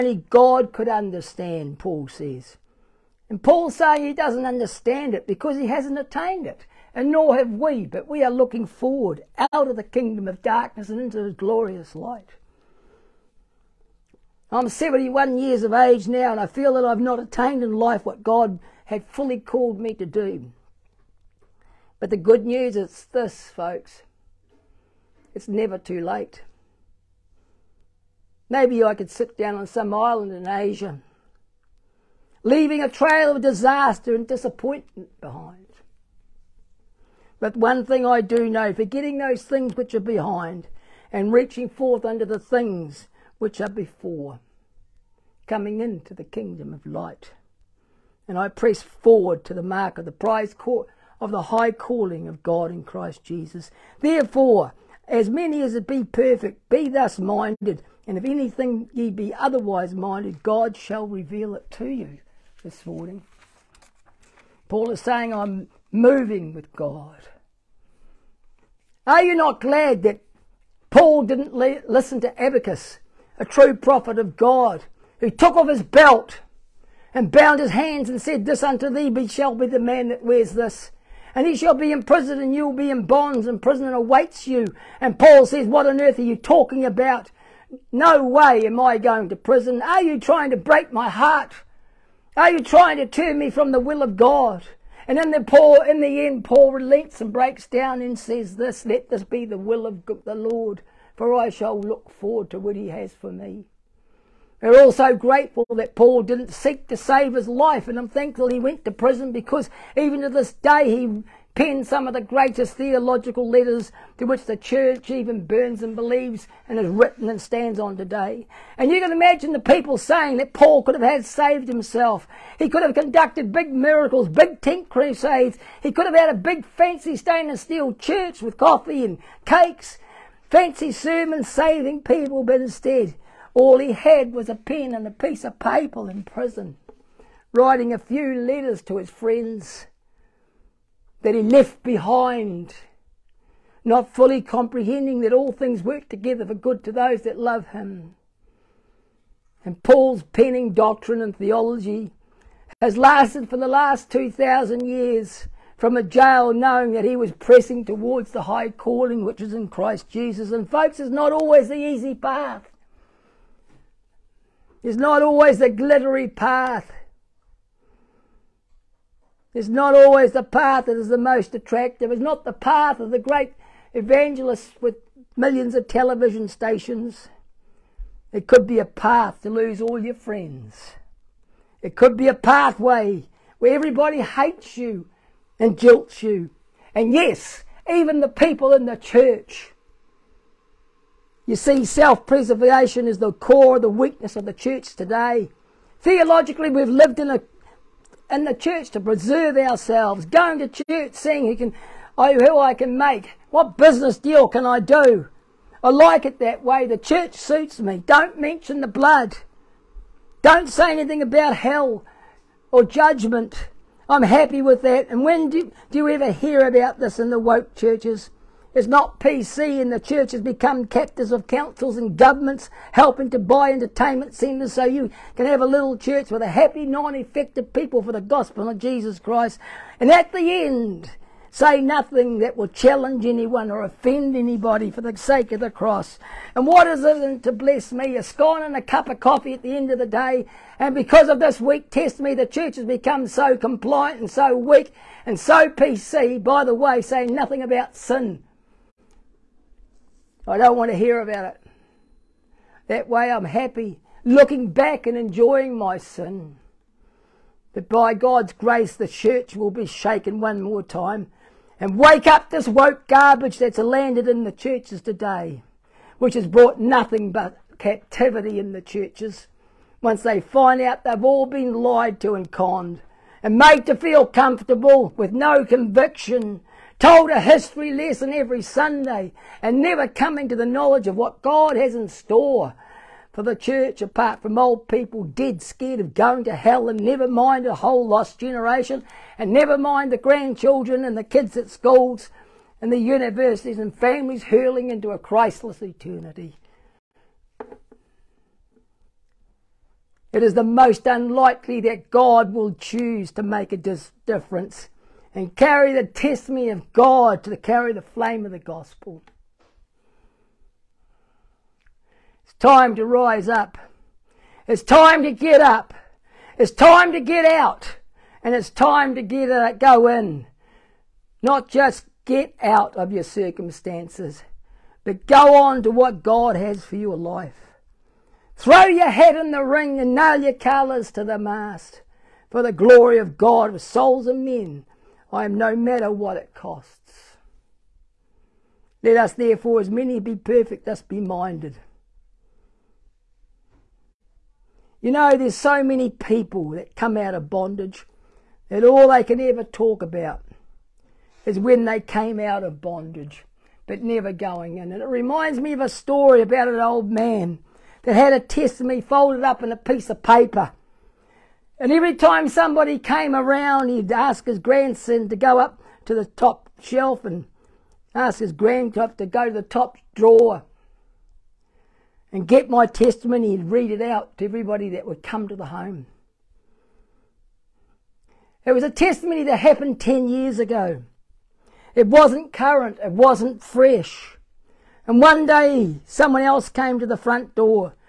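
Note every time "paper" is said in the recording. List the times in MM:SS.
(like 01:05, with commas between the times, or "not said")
02:15, 06:00.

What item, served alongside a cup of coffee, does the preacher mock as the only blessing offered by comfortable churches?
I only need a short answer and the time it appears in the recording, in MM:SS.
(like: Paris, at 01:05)
A scone, at 03:58.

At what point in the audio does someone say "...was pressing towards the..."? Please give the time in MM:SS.
02:37.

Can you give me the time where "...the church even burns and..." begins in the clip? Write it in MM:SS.
01:54.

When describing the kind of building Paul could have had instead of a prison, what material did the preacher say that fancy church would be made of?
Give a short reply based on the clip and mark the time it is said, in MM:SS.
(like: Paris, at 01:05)
stainless steel, at 02:07.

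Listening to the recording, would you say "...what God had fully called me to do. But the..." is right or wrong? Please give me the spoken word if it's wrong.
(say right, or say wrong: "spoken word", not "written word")
right.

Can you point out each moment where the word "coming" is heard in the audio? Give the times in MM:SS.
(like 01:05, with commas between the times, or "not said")
00:45, 04:40.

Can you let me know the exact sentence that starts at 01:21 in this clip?
And he shall be in prison, and you will be in bonds, and prison awaits you.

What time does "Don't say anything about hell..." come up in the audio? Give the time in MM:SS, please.
03:30.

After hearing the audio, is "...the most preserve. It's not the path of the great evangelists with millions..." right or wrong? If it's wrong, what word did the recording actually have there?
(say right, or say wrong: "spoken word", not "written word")
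wrong: "attractive", not "preserve".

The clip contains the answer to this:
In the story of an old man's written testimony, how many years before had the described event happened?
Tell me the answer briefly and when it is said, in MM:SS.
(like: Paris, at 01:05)
10, at 06:20.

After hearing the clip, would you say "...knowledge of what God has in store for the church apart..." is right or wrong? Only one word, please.
right.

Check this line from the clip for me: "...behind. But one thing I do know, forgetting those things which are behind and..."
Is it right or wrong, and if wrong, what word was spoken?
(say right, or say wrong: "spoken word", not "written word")
right.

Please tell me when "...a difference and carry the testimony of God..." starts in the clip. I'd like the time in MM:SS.
05:03.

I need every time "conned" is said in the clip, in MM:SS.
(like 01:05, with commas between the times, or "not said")
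04:32.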